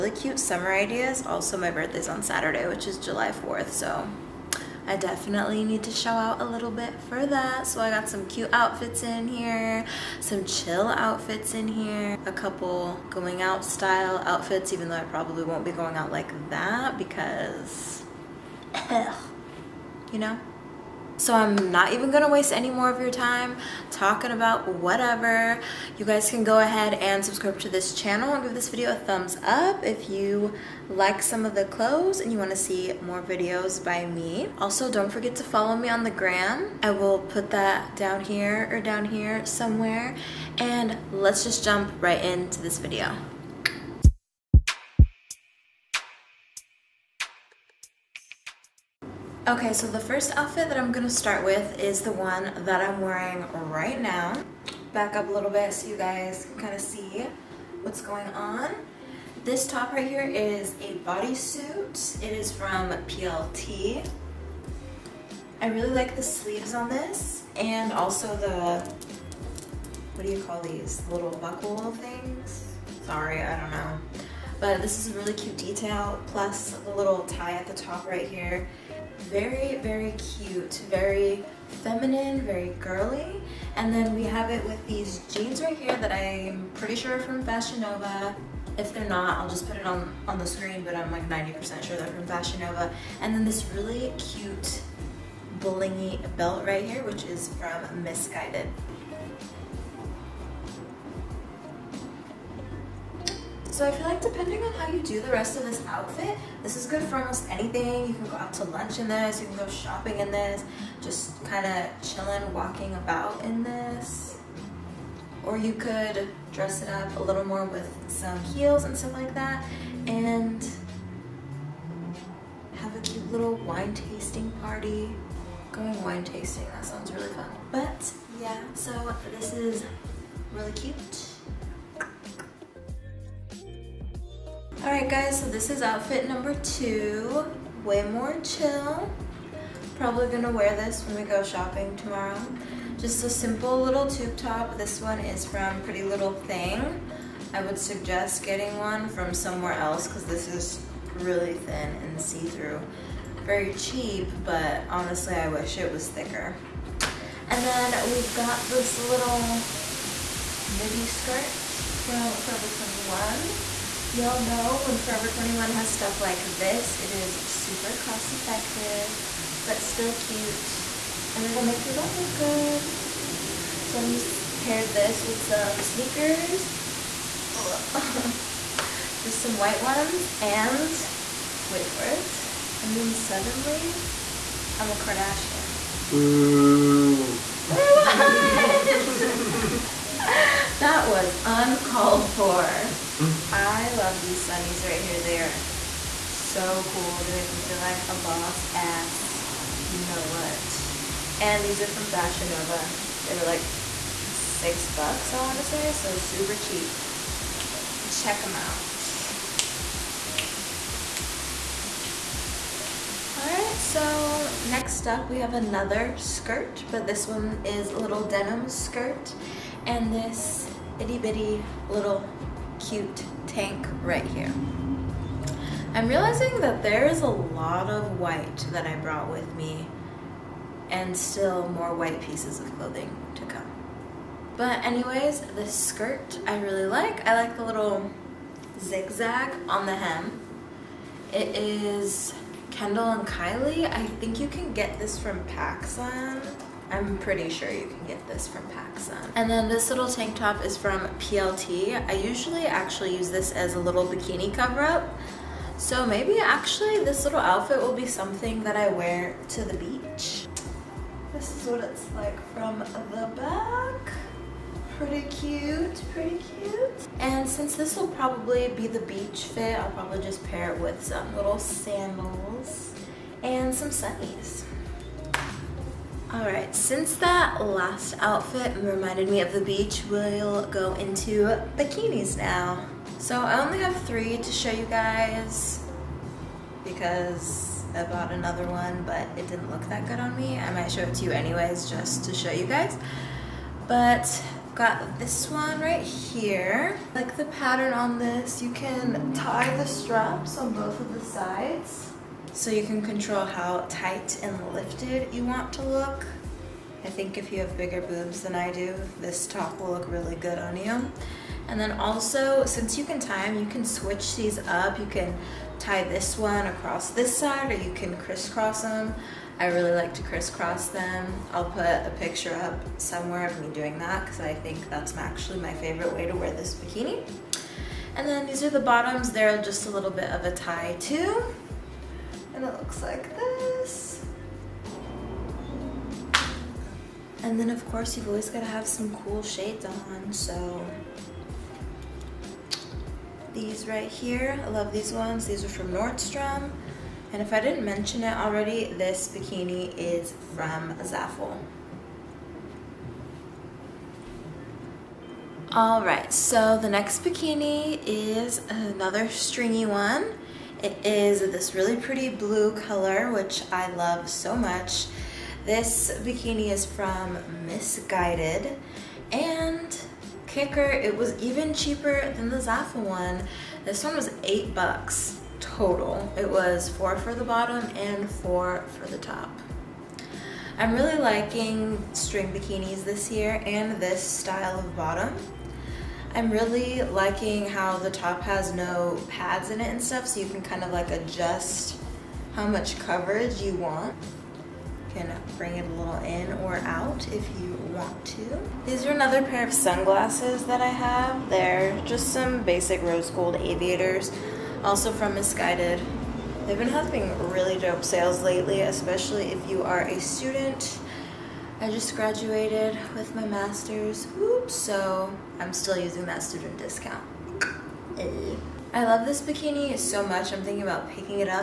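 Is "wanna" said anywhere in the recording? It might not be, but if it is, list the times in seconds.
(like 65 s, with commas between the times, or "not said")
32 s, 205 s.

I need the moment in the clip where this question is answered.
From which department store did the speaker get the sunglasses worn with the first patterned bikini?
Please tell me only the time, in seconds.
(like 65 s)
345 s.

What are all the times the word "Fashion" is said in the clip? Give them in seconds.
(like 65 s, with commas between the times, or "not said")
87 s, 92 s, 202 s.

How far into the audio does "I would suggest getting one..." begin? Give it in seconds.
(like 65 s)
147 s.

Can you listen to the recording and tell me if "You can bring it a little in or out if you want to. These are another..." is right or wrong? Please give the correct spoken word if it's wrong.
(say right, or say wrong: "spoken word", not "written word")
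right.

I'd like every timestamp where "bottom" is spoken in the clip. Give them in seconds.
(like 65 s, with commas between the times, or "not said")
328 s, 377 s, 384 s.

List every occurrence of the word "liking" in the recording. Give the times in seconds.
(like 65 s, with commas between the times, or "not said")
381 s, 387 s.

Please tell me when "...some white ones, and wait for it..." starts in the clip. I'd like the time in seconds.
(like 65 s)
179 s.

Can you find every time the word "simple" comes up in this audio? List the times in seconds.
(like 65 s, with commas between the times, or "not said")
143 s.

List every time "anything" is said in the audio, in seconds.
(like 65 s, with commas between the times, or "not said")
107 s.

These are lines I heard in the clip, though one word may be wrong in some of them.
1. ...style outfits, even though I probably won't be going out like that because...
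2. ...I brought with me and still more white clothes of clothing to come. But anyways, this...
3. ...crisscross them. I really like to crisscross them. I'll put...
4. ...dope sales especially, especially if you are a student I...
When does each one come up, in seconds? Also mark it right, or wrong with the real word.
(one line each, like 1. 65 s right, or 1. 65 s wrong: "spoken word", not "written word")
1. 13 s right
2. 228 s wrong: "pieces", not "clothes"
3. 318 s right
4. 407 s wrong: "lately", not "especially".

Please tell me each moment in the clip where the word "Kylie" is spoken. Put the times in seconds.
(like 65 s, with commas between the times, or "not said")
243 s.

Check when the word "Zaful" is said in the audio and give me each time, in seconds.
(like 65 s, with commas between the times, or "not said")
351 s, 372 s.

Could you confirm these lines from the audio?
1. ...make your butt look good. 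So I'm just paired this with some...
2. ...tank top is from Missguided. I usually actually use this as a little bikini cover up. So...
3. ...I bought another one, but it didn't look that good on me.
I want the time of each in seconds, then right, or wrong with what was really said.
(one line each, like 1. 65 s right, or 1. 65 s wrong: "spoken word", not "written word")
1. 171 s right
2. 250 s wrong: "PLT", not "Missguided"
3. 287 s right.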